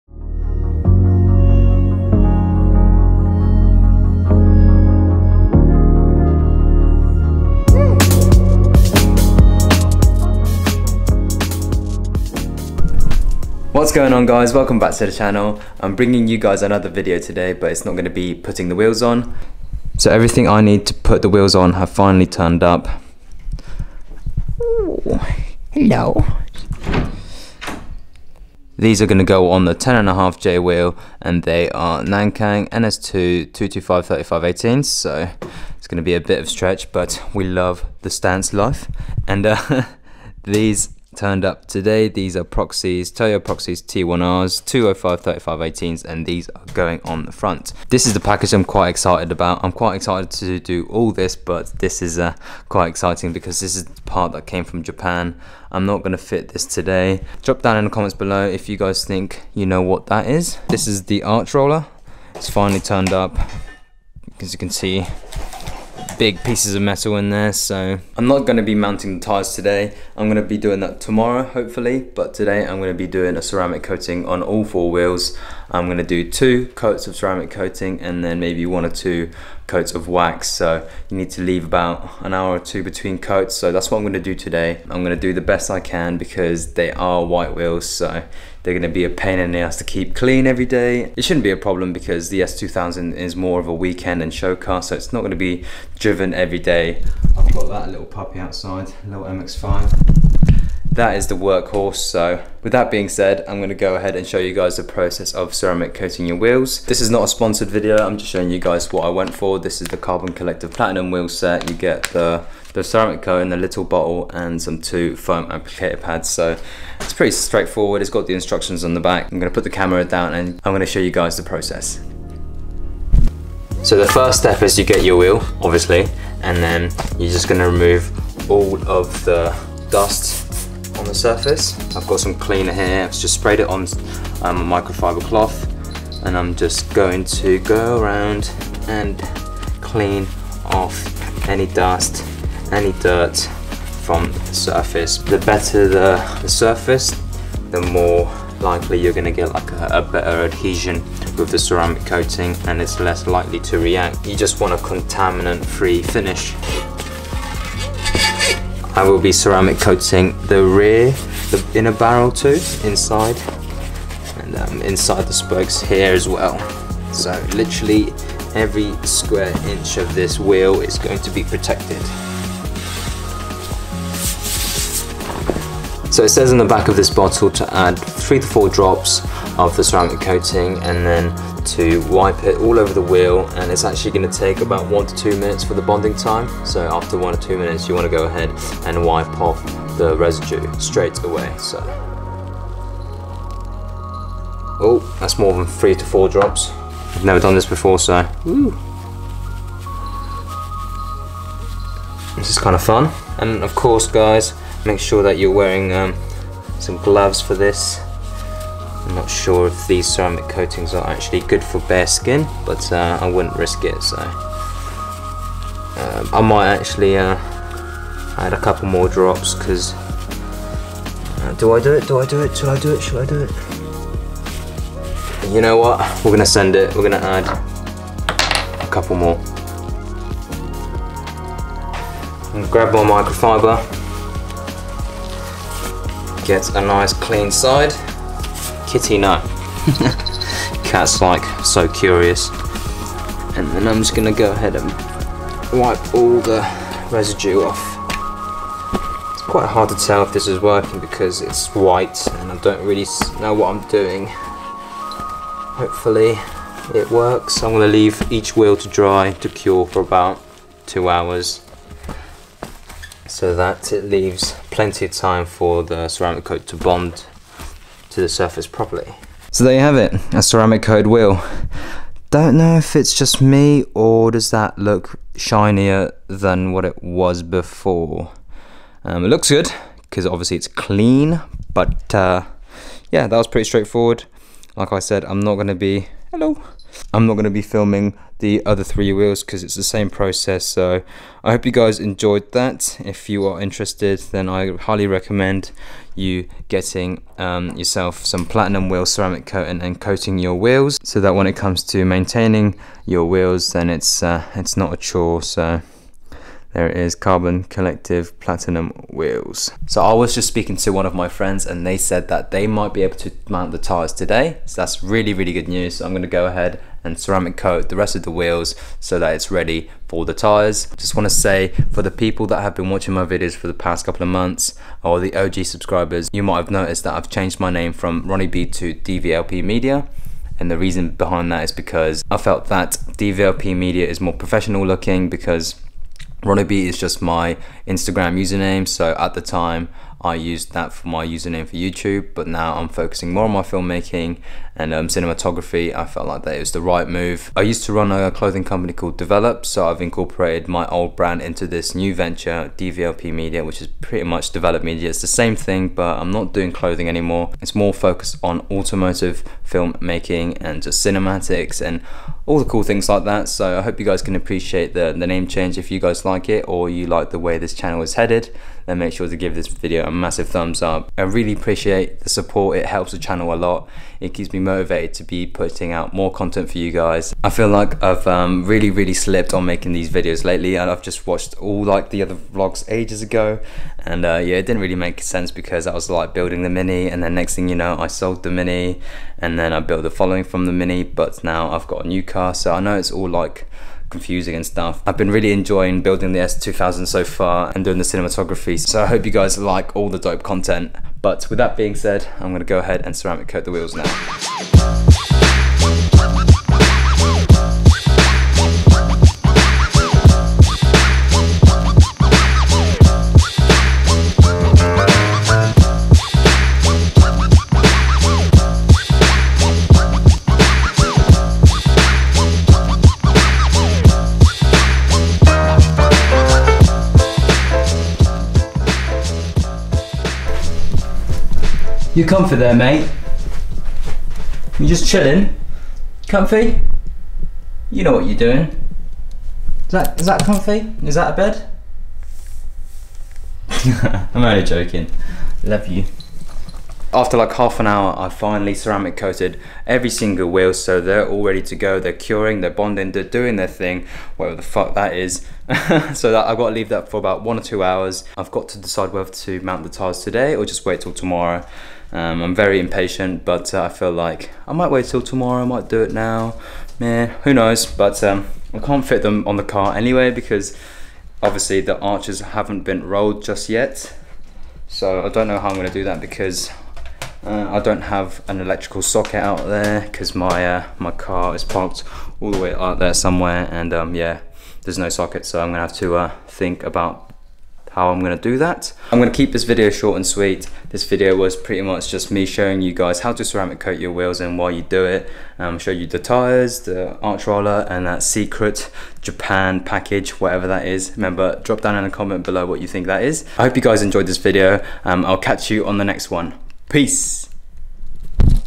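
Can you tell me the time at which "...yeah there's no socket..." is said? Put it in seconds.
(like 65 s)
484 s.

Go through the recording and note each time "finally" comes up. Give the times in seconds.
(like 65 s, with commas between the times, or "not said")
21 s, 62 s, 448 s.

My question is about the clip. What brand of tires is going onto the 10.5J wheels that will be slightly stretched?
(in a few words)
Nankang NS2.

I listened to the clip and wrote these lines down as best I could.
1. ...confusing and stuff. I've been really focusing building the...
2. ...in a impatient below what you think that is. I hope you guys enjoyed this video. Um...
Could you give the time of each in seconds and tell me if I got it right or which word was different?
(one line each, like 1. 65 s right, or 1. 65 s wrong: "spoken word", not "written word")
1. 394 s wrong: "enjoying", not "focusing"
2. 501 s wrong: "comment", not "impatient".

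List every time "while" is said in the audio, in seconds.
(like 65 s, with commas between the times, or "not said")
494 s.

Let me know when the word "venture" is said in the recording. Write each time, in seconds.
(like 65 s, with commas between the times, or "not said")
352 s.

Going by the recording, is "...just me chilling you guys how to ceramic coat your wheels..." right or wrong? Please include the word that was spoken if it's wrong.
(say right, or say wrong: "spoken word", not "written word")
wrong: "showing", not "chilling".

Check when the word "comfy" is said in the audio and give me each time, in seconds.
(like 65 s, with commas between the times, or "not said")
432 s, 436 s, 440 s.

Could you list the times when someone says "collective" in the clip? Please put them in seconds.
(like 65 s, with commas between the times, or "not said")
110 s, 307 s.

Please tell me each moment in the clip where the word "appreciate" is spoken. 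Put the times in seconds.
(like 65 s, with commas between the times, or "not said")
364 s, 371 s.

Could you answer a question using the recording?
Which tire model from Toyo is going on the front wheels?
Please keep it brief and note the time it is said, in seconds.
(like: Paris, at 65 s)
Proxes T1R, at 43 s.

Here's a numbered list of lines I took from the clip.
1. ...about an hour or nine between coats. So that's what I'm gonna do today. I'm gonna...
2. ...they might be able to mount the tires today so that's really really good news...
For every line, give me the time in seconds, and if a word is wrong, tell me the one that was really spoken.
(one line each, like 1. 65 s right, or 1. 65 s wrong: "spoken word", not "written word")
1. 81 s wrong: "two", not "nine"
2. 312 s right.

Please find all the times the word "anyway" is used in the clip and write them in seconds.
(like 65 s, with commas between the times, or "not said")
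469 s.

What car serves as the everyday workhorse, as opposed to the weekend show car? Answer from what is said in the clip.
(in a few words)
MX-5.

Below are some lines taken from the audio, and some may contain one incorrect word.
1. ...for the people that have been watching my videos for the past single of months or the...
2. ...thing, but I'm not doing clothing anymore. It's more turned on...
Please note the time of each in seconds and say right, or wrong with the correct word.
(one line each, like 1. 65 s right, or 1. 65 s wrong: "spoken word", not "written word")
1. 321 s wrong: "couple", not "single"
2. 355 s wrong: "focused", not "turned".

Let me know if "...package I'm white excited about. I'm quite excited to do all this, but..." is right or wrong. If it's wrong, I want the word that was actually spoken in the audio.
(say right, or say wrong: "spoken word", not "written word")
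wrong: "quite", not "white".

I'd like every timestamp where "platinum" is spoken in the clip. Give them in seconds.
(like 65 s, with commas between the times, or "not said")
110 s, 298 s, 308 s.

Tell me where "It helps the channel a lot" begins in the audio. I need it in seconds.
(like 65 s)
372 s.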